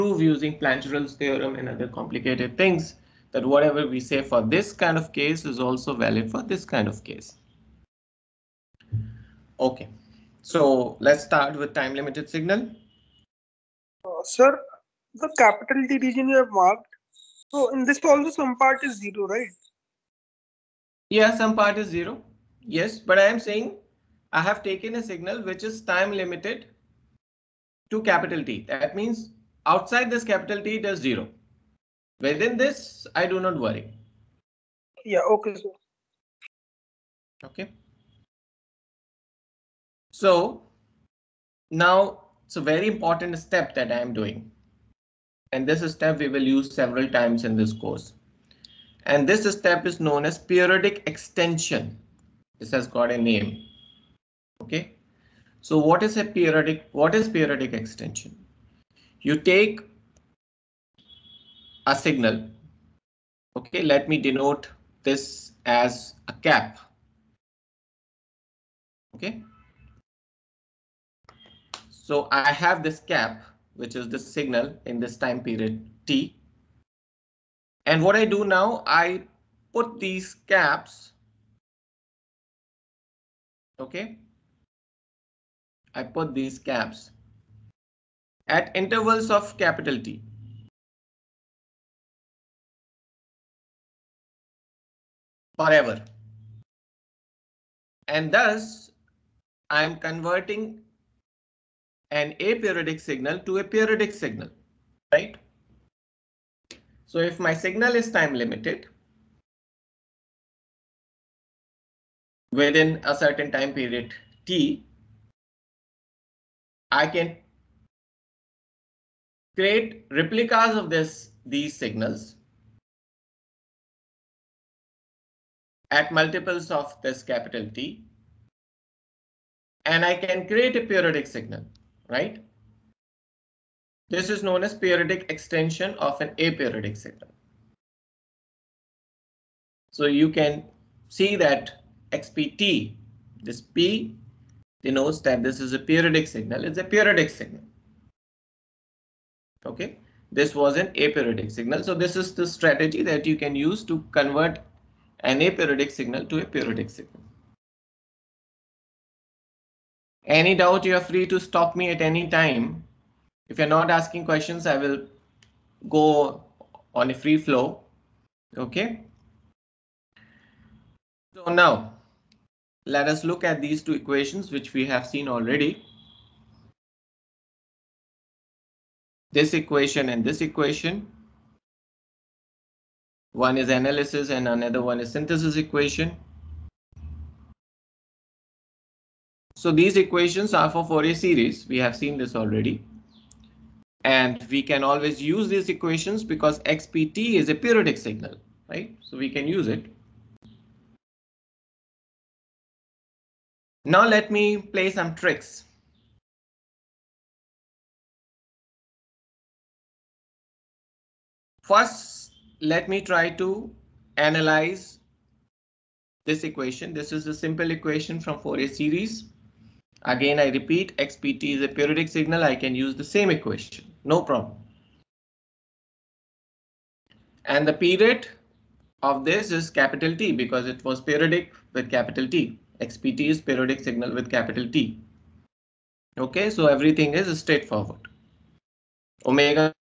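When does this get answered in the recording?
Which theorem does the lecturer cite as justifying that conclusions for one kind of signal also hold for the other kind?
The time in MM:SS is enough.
00:00.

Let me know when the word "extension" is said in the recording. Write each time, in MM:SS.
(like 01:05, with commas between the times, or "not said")
00:51, 00:57, 02:15.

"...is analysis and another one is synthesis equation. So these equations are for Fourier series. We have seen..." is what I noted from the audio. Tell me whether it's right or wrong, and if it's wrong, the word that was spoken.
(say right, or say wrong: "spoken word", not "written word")
right.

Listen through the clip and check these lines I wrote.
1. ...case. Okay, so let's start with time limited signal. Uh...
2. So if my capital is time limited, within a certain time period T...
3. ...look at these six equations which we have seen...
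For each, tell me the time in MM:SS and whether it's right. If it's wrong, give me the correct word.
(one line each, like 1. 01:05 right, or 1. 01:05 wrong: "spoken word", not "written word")
1. 00:07 right
2. 01:47 wrong: "signal", not "capital"
3. 02:53 wrong: "two", not "six".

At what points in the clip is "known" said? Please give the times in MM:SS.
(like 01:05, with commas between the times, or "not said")
00:50, 02:14.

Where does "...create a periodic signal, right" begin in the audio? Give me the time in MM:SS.
02:10.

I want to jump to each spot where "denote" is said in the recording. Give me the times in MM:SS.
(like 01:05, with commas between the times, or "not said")
01:04, 02:24.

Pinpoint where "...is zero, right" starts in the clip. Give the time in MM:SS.
00:18.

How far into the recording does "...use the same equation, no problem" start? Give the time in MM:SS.
03:42.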